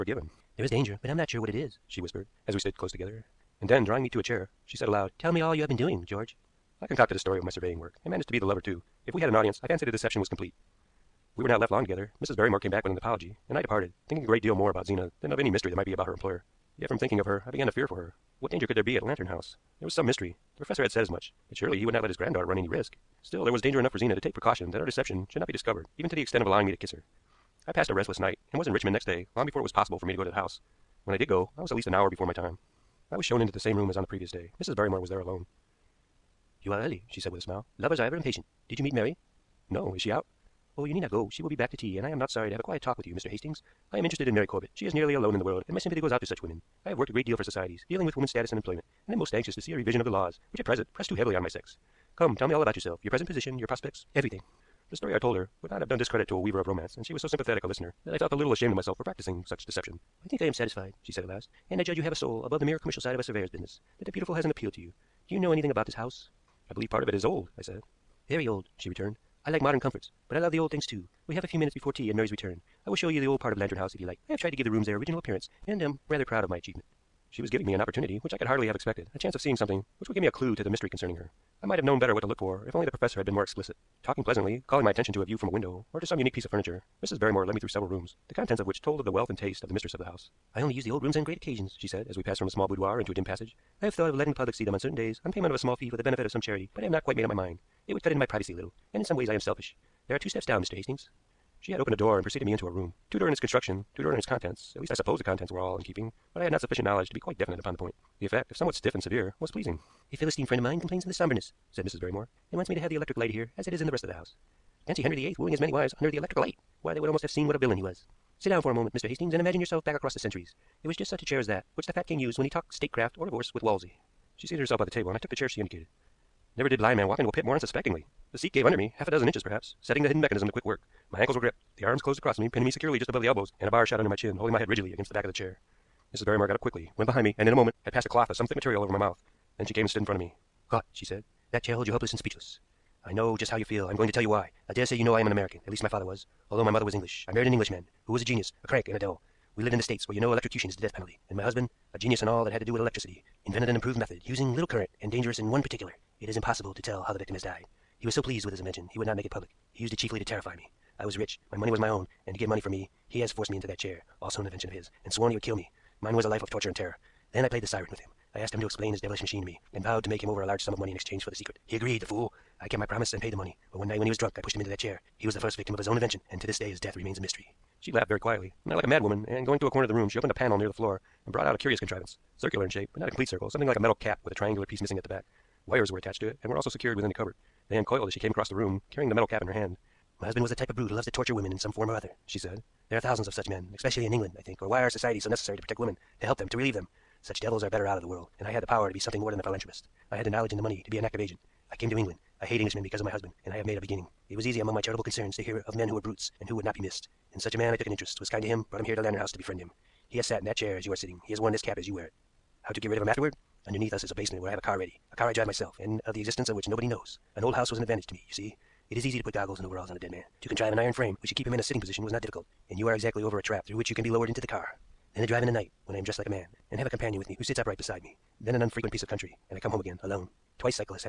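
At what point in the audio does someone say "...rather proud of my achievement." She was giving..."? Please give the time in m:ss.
1:16.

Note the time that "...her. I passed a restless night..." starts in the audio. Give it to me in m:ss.
0:26.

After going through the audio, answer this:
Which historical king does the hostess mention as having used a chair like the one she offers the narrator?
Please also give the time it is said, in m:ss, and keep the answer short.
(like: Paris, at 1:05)
Henry VIII, at 1:55.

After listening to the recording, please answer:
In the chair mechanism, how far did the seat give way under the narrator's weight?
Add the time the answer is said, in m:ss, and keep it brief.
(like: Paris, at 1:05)
half a dozen inches, at 2:08.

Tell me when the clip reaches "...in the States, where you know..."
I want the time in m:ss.
2:29.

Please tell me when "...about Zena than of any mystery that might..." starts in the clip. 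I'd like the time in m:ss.
0:14.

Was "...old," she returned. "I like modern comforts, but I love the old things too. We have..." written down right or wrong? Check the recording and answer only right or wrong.
right.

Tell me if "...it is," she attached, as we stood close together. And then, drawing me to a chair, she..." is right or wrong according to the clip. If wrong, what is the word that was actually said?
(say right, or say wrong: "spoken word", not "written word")
wrong: "whispered", not "attached".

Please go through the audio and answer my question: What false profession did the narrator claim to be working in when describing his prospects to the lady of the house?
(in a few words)
surveyor.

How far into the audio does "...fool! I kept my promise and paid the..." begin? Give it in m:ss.
2:52.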